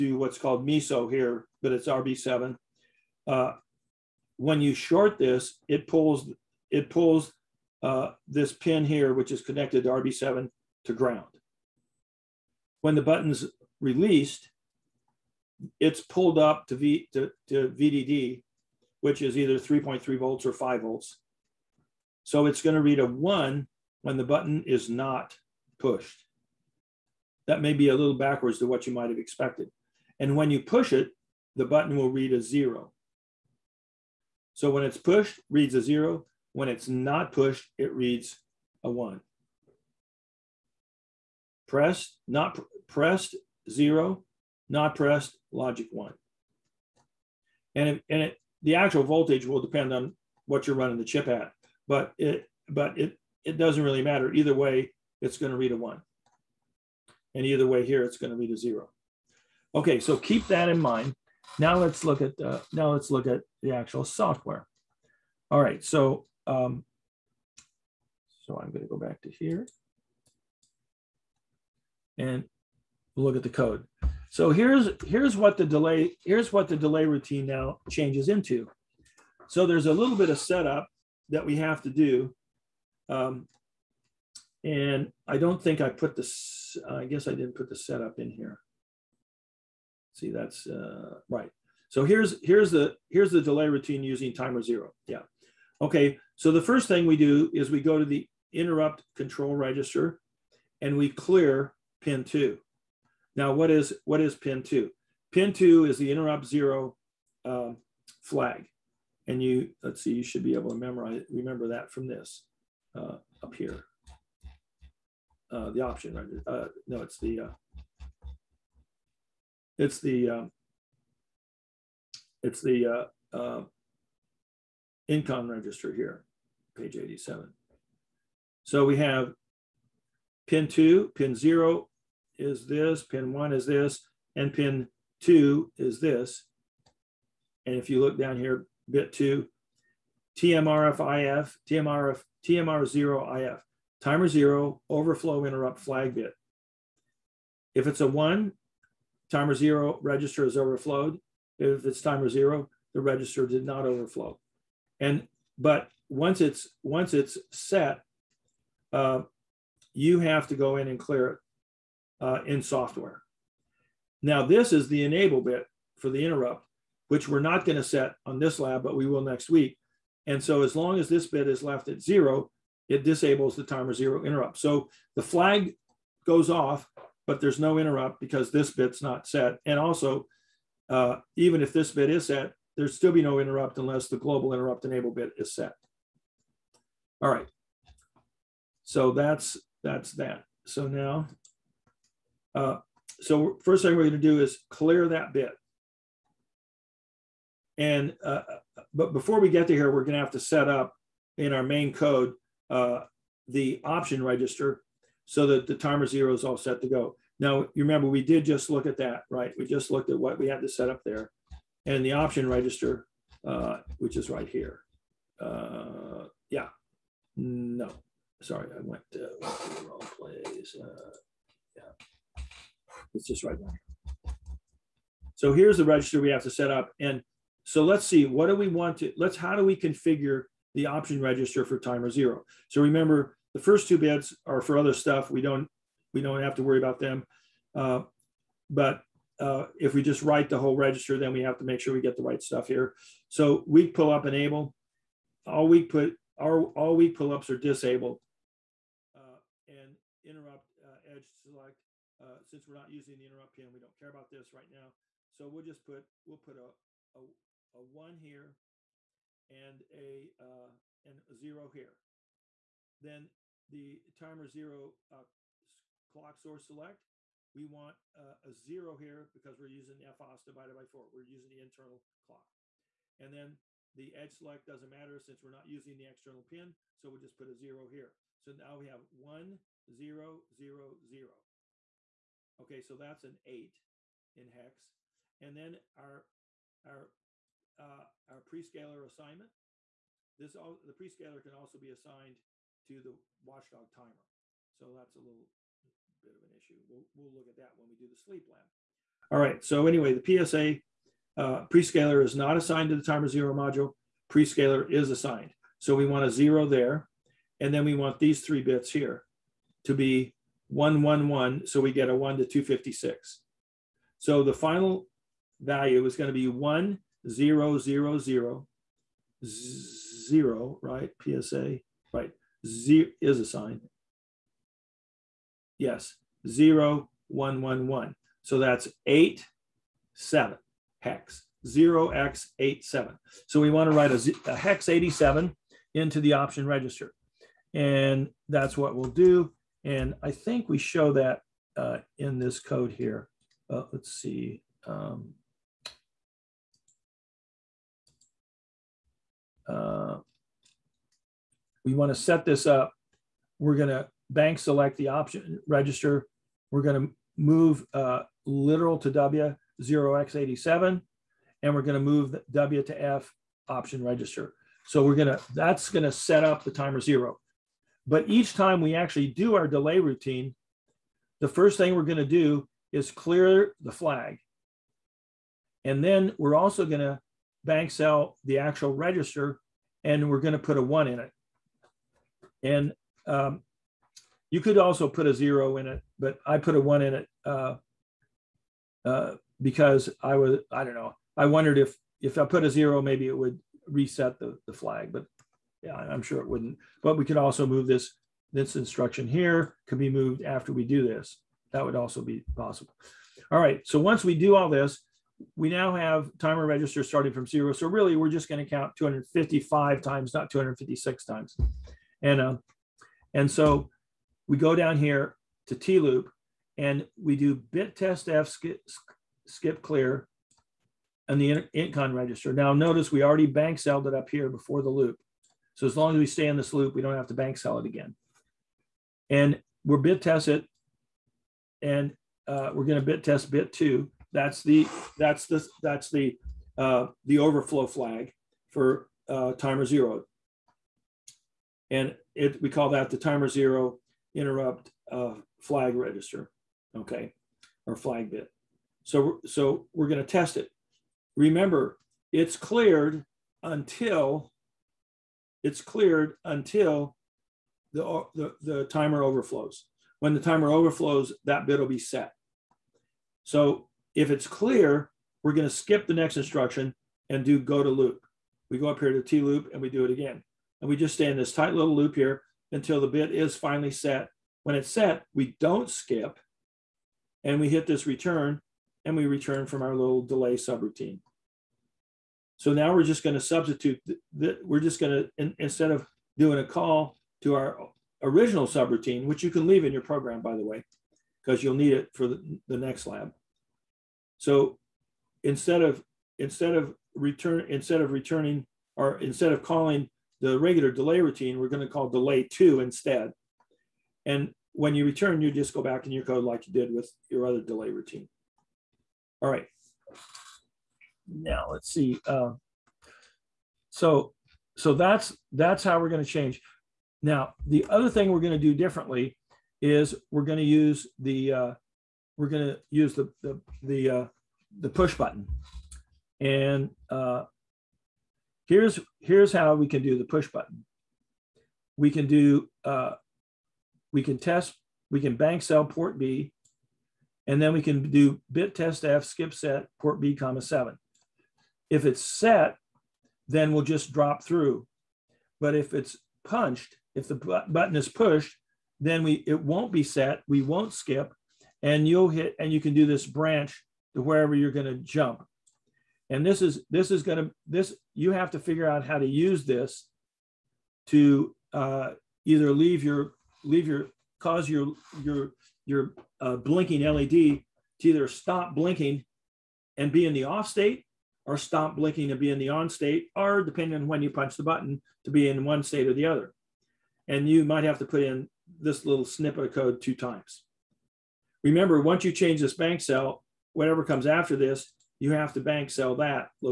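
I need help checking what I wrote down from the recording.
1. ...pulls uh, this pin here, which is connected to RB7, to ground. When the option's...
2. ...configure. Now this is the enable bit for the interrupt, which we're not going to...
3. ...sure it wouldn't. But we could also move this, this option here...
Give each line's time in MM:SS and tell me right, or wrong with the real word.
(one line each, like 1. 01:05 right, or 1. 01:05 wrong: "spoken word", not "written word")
1. 00:06 wrong: "button", not "option"
2. 02:42 wrong: "software", not "configure"
3. 06:36 wrong: "instruction", not "option".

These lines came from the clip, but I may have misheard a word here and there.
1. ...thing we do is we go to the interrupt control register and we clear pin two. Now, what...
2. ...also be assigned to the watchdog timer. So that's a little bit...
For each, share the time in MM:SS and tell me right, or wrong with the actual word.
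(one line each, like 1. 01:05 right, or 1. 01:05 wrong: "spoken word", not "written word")
1. 01:36 right
2. 04:51 right.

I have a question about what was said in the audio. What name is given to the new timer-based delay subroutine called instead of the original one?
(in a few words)
delay two.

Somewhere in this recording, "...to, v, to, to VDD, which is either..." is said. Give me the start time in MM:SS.
00:16.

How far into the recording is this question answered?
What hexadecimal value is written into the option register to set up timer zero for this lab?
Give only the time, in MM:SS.
05:34.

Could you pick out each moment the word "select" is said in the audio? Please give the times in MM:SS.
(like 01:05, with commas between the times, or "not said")
04:11, 04:26, 04:34, 05:54.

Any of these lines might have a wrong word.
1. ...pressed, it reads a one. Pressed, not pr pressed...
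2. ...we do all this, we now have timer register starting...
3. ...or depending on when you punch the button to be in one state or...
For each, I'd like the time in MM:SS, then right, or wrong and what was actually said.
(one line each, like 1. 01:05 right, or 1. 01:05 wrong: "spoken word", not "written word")
1. 00:37 wrong: "pushed", not "pressed"
2. 06:44 right
3. 09:33 right.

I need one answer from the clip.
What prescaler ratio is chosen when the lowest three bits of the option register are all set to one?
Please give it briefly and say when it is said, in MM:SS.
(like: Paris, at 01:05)
1 to 256, at 05:12.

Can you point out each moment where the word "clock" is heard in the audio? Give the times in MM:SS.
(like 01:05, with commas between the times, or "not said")
04:26, 04:32.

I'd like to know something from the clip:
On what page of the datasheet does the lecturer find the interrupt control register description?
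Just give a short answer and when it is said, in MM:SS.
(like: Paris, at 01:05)
page 87, at 02:06.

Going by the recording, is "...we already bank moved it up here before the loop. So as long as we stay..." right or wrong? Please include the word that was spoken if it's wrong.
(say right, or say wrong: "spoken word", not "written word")
wrong: "celled", not "moved".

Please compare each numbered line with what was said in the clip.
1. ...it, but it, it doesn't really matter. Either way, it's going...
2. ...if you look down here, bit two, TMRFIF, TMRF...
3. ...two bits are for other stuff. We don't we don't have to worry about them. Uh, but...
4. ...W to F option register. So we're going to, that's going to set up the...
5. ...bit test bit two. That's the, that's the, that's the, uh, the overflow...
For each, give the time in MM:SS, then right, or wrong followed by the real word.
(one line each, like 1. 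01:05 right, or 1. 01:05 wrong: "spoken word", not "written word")
1. 00:52 right
2. 02:17 right
3. 03:53 right
4. 06:02 right
5. 07:13 right.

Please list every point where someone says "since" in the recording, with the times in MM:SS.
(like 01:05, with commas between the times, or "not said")
04:12, 04:35.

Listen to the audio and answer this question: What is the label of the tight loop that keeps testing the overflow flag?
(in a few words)
T-loop.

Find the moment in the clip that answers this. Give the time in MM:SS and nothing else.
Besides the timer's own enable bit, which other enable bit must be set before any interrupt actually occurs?
03:04.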